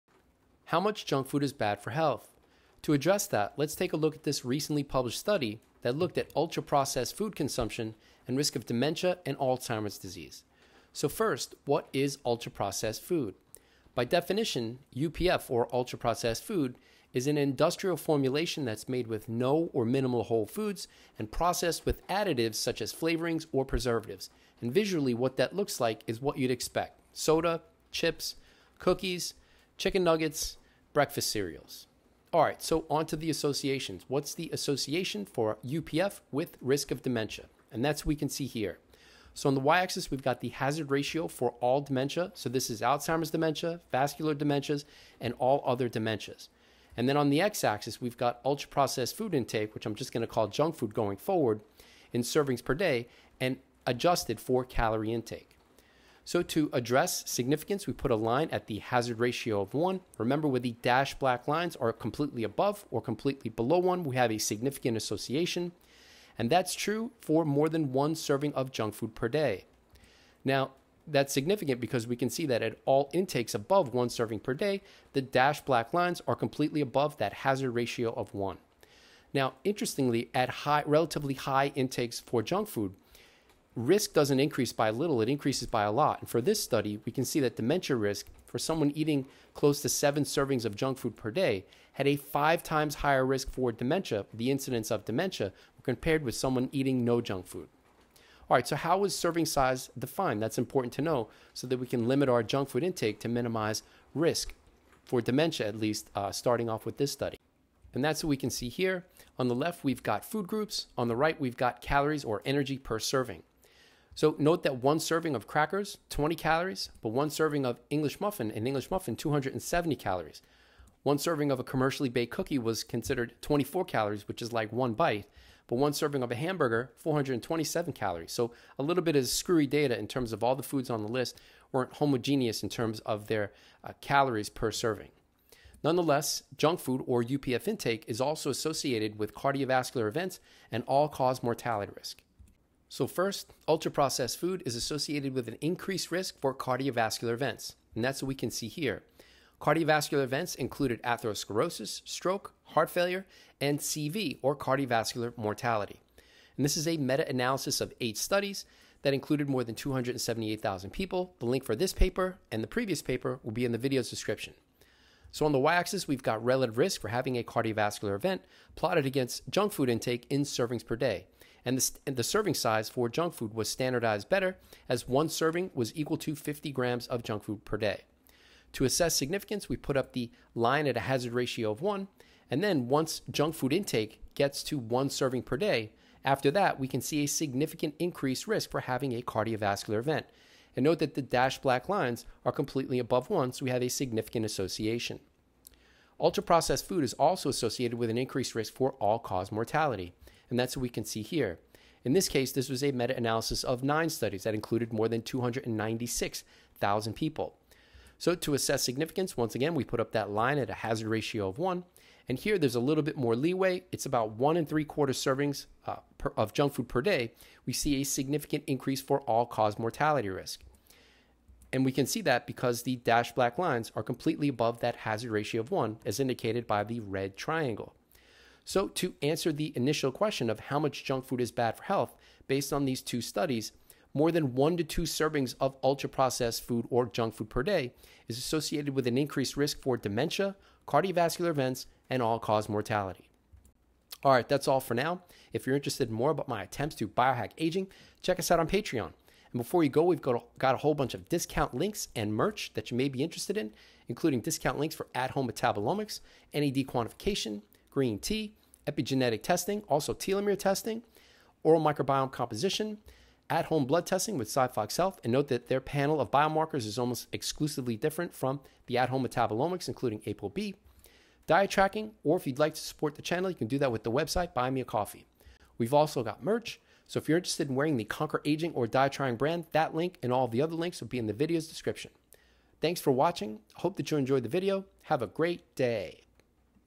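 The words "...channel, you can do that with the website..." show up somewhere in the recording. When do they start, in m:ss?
4:33.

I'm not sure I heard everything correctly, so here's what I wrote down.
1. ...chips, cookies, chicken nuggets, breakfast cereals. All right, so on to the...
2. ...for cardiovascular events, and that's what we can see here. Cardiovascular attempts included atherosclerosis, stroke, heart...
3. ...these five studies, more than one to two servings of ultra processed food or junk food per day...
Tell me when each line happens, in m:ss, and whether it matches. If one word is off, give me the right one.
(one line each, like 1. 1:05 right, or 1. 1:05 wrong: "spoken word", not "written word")
1. 0:27 right
2. 2:26 wrong: "events", not "attempts"
3. 3:52 wrong: "two", not "five".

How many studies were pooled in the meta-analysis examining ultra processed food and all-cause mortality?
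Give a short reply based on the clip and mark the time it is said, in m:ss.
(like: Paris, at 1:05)
9, at 3:23.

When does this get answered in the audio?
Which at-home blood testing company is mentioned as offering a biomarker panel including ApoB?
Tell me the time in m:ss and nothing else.
4:24.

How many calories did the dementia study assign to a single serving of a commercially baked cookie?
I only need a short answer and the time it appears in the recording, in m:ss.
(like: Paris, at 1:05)
24 calories, at 2:03.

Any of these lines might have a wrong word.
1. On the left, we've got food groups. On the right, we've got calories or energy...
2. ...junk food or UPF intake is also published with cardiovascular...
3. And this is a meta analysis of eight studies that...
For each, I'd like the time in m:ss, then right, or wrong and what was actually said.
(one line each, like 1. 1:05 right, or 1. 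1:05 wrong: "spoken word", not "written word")
1. 1:49 right
2. 2:16 wrong: "associated", not "published"
3. 2:36 right.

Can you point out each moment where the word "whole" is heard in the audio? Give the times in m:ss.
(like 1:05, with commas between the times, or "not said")
0:20, 4:10.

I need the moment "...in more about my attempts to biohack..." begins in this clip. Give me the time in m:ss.
4:06.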